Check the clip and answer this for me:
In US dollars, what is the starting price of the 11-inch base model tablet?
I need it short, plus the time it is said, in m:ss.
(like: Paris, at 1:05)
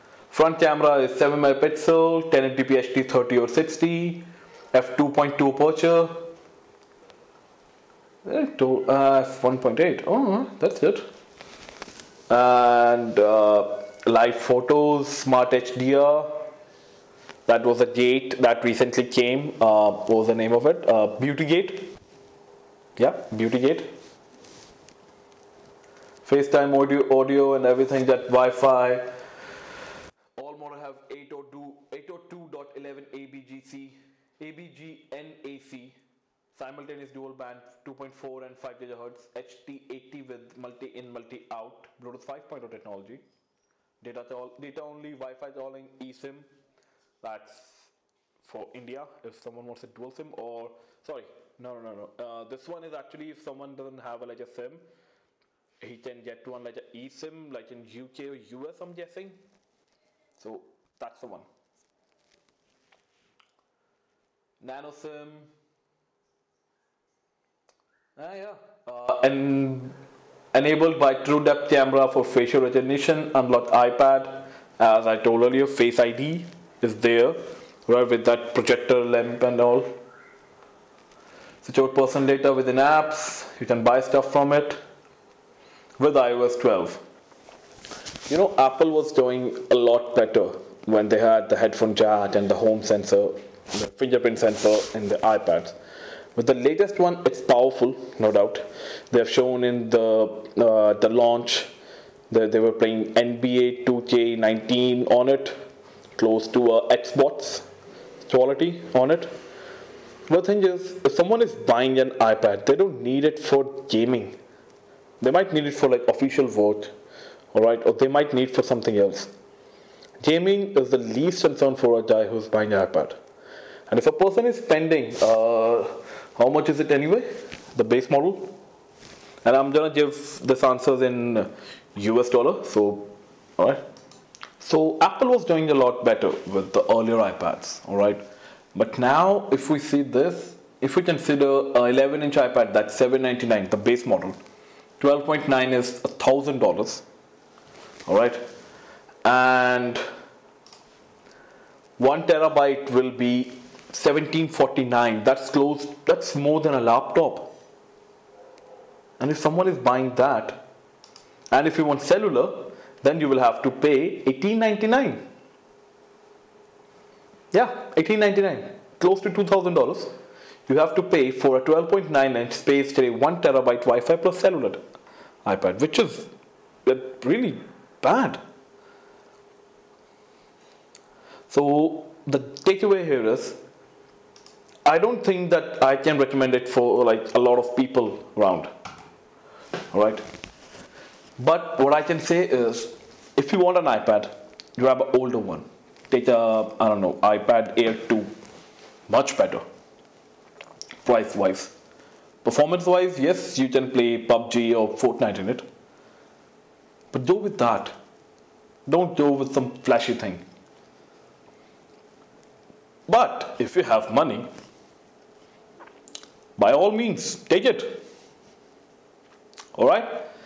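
$799, at 2:22.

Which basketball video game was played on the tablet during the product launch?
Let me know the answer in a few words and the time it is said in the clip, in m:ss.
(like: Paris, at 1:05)
NBA 2K19, at 1:43.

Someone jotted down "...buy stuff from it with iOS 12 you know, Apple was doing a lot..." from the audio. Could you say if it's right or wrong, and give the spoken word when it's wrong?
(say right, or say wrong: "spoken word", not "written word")
right.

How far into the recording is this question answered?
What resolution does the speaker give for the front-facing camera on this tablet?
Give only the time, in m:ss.
0:01.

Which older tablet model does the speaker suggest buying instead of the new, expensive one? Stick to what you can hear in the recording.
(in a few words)
iPad Air 2.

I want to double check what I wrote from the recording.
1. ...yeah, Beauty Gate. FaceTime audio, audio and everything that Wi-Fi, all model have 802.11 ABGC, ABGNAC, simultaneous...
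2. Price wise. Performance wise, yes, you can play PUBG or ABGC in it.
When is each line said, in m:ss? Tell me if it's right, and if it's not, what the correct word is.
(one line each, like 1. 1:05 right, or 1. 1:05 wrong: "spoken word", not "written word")
1. 0:22 right
2. 3:21 wrong: "Fortnite", not "ABGC".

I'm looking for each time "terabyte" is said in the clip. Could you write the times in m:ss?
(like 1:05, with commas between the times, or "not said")
2:32, 2:53.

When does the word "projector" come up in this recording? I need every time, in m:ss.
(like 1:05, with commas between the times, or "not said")
1:18.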